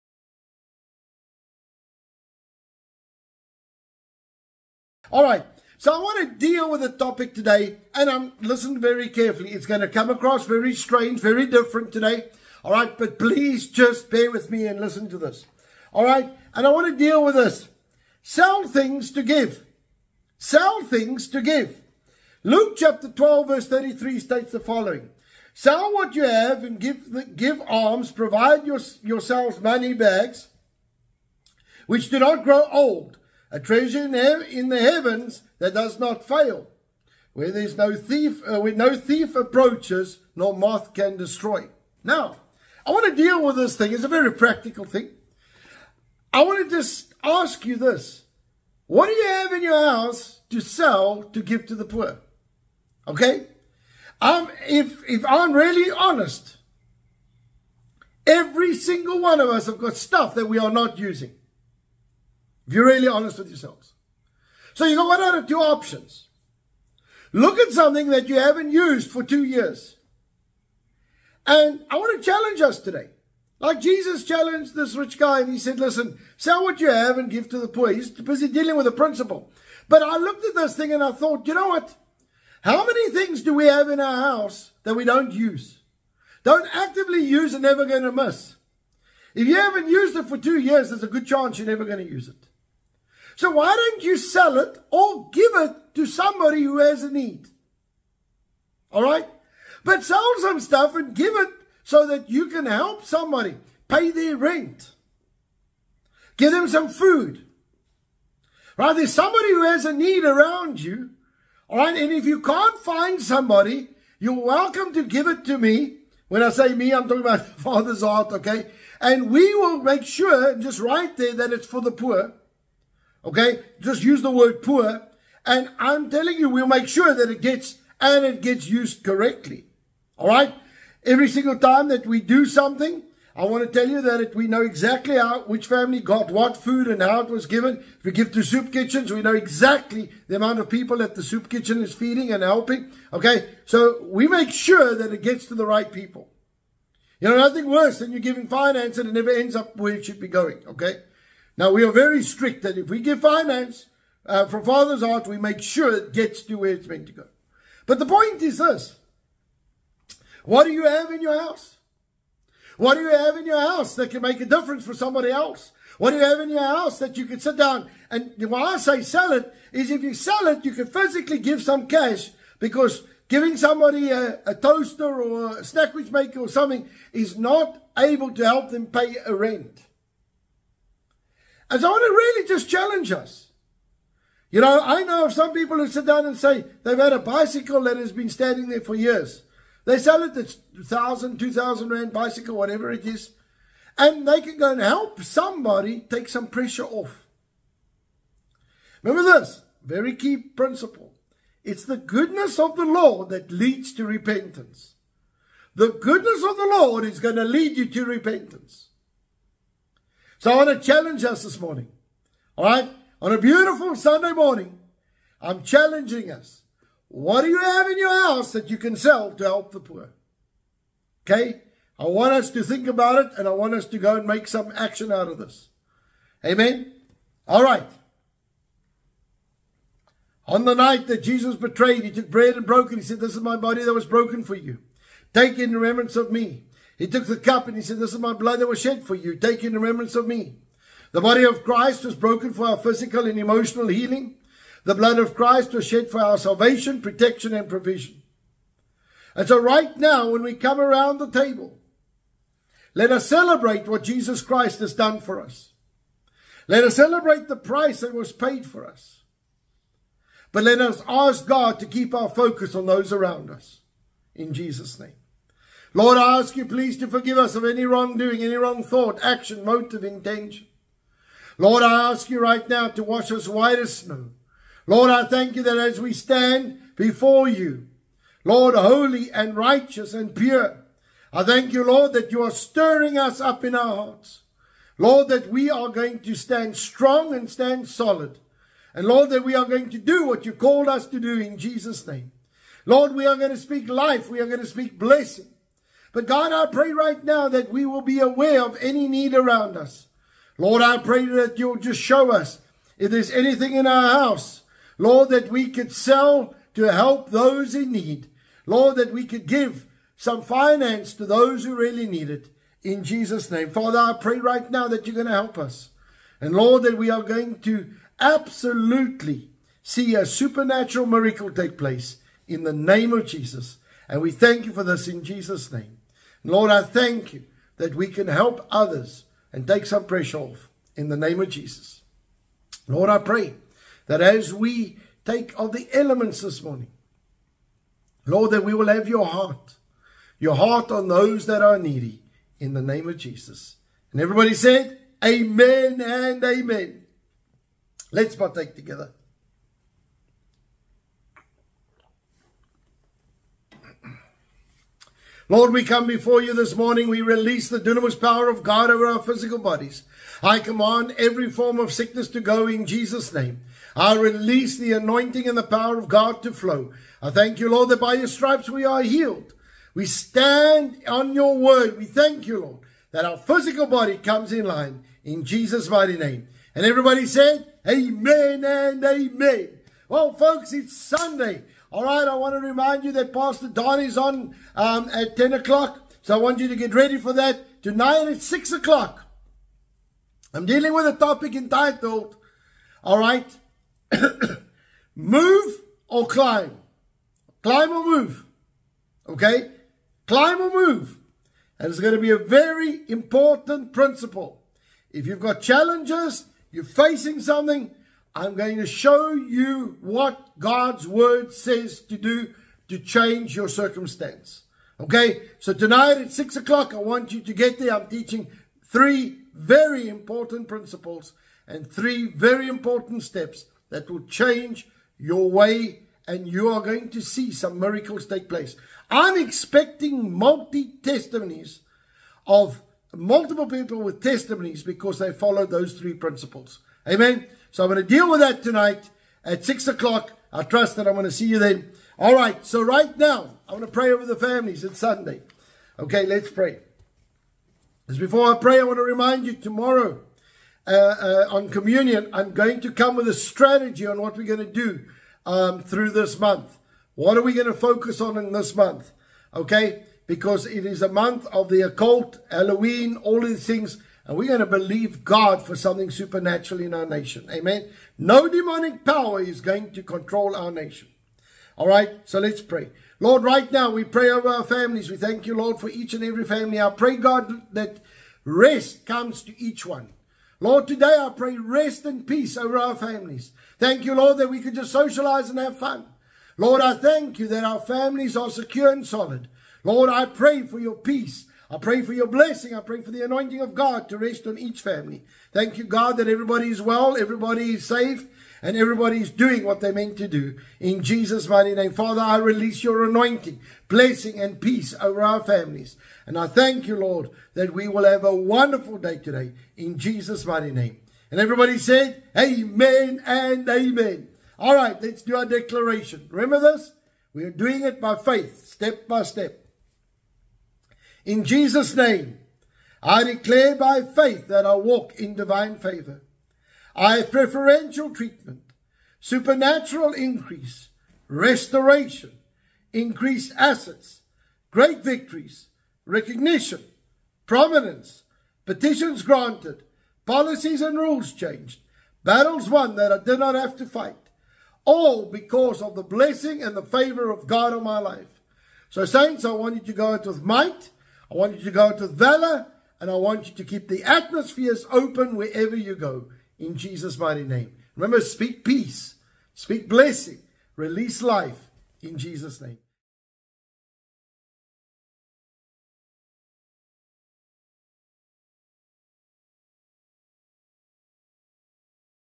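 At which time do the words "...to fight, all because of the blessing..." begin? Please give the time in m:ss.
9:03.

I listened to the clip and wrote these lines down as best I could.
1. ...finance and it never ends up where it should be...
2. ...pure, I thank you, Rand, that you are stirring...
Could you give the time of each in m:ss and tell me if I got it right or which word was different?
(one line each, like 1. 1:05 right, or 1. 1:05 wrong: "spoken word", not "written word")
1. 2:28 right
2. 4:40 wrong: "Lord", not "Rand".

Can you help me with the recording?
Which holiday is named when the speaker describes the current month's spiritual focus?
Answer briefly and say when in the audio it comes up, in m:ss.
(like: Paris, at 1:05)
Halloween, at 7:42.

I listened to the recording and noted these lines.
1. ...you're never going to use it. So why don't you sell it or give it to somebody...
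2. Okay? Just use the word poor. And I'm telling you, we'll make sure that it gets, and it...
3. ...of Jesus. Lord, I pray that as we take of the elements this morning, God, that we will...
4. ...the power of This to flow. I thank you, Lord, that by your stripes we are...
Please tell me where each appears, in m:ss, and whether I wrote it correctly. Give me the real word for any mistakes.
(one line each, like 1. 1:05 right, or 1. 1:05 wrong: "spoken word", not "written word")
1. 1:31 right
2. 2:03 right
3. 5:31 wrong: "Lord", not "God"
4. 6:05 wrong: "God", not "This".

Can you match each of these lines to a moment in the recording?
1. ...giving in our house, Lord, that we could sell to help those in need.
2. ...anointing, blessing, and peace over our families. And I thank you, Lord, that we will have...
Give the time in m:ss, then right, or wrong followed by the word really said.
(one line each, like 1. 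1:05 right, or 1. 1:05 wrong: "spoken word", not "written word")
1. 5:03 wrong: "anything", not "giving"
2. 8:23 right.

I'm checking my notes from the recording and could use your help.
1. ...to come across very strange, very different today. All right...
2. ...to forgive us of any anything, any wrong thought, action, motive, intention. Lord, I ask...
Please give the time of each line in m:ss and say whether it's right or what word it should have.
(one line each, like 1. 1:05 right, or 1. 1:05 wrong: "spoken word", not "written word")
1. 0:09 right
2. 4:26 wrong: "wrongdoing", not "anything".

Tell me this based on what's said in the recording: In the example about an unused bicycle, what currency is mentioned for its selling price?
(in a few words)
Rand.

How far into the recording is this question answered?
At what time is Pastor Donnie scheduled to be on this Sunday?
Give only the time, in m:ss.
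6:25.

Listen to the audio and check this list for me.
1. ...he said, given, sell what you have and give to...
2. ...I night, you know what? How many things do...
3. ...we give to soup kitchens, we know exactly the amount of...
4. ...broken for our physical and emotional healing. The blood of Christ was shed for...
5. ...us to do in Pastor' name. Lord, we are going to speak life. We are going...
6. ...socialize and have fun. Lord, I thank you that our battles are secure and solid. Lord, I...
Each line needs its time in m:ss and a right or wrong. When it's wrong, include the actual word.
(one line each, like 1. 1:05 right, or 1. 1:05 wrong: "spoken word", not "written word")
1. 1:15 wrong: "listen", not "given"
2. 1:21 wrong: "thought", not "night"
3. 2:18 right
4. 4:02 right
5. 4:50 wrong: "Jesus", not "Pastor"
6. 8:04 wrong: "families", not "battles".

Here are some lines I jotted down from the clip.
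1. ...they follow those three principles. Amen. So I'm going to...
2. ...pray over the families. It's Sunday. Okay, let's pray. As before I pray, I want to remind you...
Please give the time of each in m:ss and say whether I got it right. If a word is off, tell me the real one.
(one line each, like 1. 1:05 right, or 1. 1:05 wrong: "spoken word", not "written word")
1. 7:15 right
2. 7:23 right.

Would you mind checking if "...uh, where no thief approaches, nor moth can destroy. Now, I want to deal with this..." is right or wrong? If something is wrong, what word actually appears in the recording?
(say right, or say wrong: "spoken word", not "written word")
right.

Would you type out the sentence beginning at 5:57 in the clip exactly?
We release the dunamis power of God over our physical bodies.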